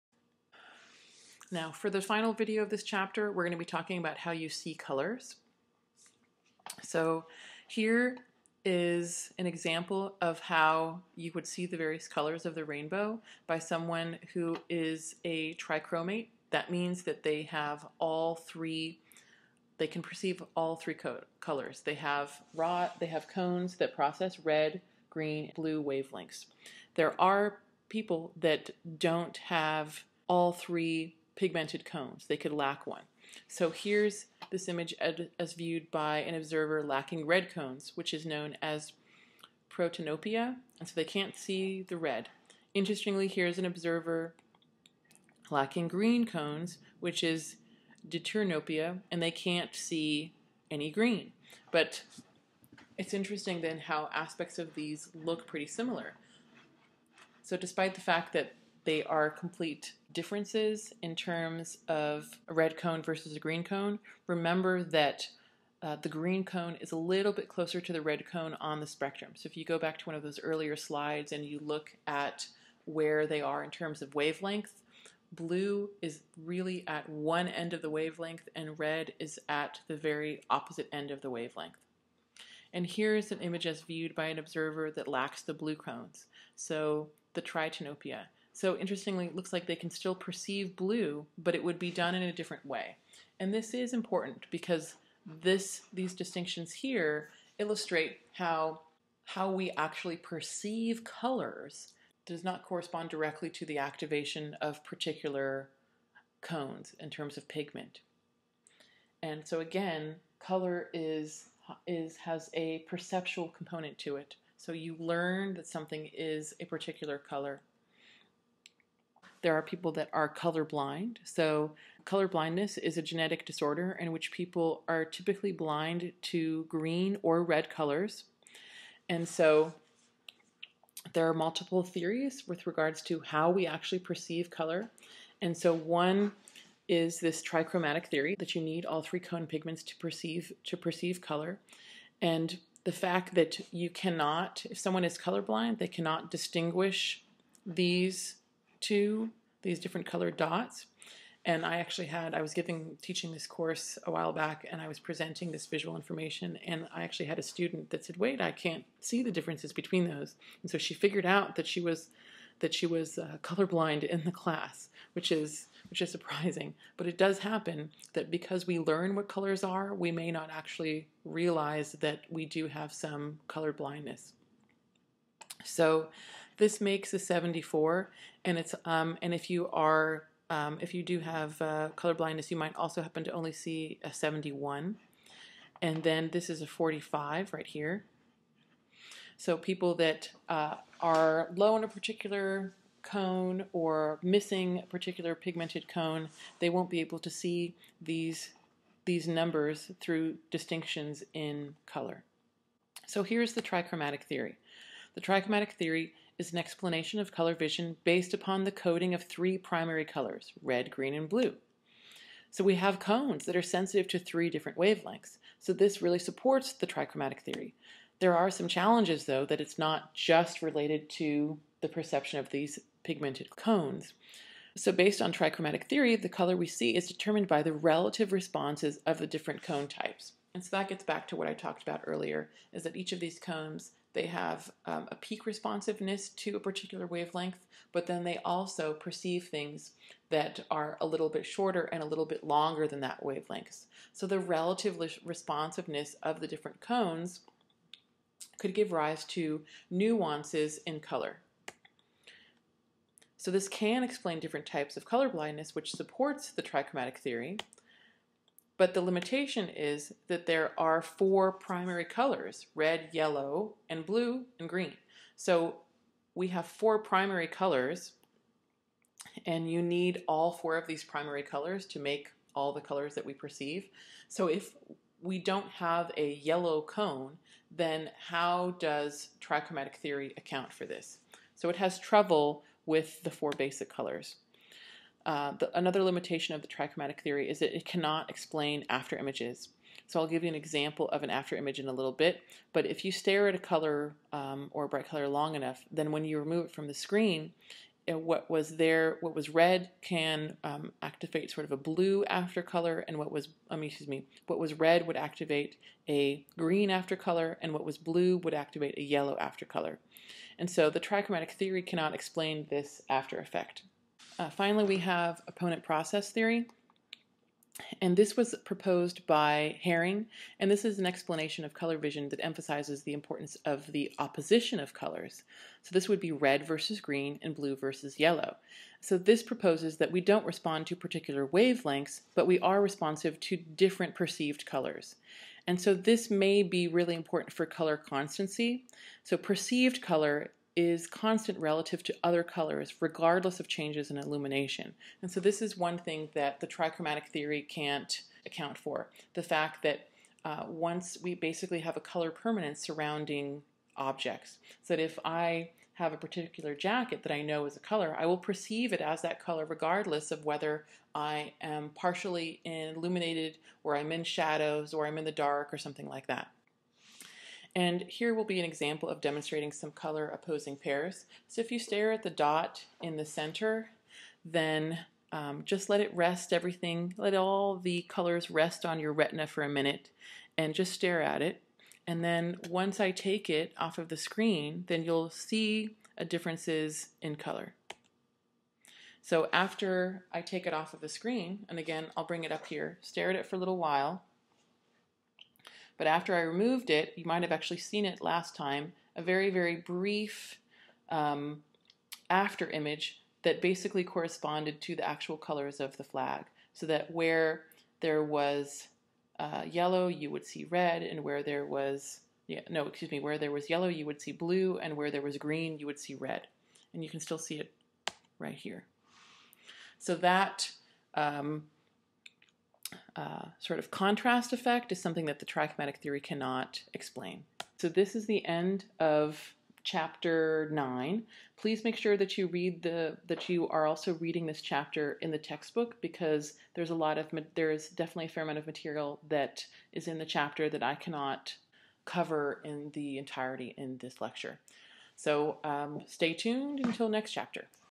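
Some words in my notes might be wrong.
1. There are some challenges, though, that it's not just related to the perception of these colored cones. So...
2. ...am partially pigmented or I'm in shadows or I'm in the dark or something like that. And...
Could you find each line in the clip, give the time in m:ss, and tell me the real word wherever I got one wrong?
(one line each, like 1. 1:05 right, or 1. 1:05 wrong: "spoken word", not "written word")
1. 3:38 wrong: "pigmented", not "colored"
2. 6:01 wrong: "illuminated", not "pigmented".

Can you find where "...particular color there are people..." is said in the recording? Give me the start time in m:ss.
1:56.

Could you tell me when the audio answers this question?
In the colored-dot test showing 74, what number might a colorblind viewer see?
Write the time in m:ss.
3:04.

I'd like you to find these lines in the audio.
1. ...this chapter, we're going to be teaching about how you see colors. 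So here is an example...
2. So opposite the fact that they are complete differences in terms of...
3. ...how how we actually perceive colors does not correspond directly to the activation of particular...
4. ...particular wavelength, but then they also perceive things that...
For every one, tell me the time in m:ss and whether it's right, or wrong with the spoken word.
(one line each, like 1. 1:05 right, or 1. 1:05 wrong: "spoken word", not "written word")
1. 0:02 wrong: "talking", not "teaching"
2. 0:57 wrong: "despite", not "opposite"
3. 1:38 right
4. 3:56 right.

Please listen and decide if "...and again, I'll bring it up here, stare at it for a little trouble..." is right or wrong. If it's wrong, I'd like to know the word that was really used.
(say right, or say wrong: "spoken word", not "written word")
wrong: "while", not "trouble".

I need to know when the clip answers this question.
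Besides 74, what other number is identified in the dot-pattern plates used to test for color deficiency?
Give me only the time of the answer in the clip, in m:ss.
3:06.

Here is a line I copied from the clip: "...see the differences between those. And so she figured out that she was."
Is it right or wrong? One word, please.
right.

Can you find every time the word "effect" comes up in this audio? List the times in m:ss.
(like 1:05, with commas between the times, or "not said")
5:13, 7:04.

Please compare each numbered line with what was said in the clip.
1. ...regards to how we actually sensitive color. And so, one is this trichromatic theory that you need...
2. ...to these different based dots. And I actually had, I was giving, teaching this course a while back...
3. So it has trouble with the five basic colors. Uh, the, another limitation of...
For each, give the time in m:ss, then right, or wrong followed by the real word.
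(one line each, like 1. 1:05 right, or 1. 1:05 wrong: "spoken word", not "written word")
1. 2:12 wrong: "perceive", not "sensitive"
2. 2:28 wrong: "colored", not "based"
3. 4:41 wrong: "four", not "five".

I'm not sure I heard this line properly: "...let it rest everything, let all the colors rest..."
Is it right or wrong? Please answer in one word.
right.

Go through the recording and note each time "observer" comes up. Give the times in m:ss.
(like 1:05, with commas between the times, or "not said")
0:36, 0:43, 1:24.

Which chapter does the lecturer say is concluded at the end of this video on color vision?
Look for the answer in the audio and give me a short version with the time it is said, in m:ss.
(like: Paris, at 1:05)
Chapter 9, at 7:09.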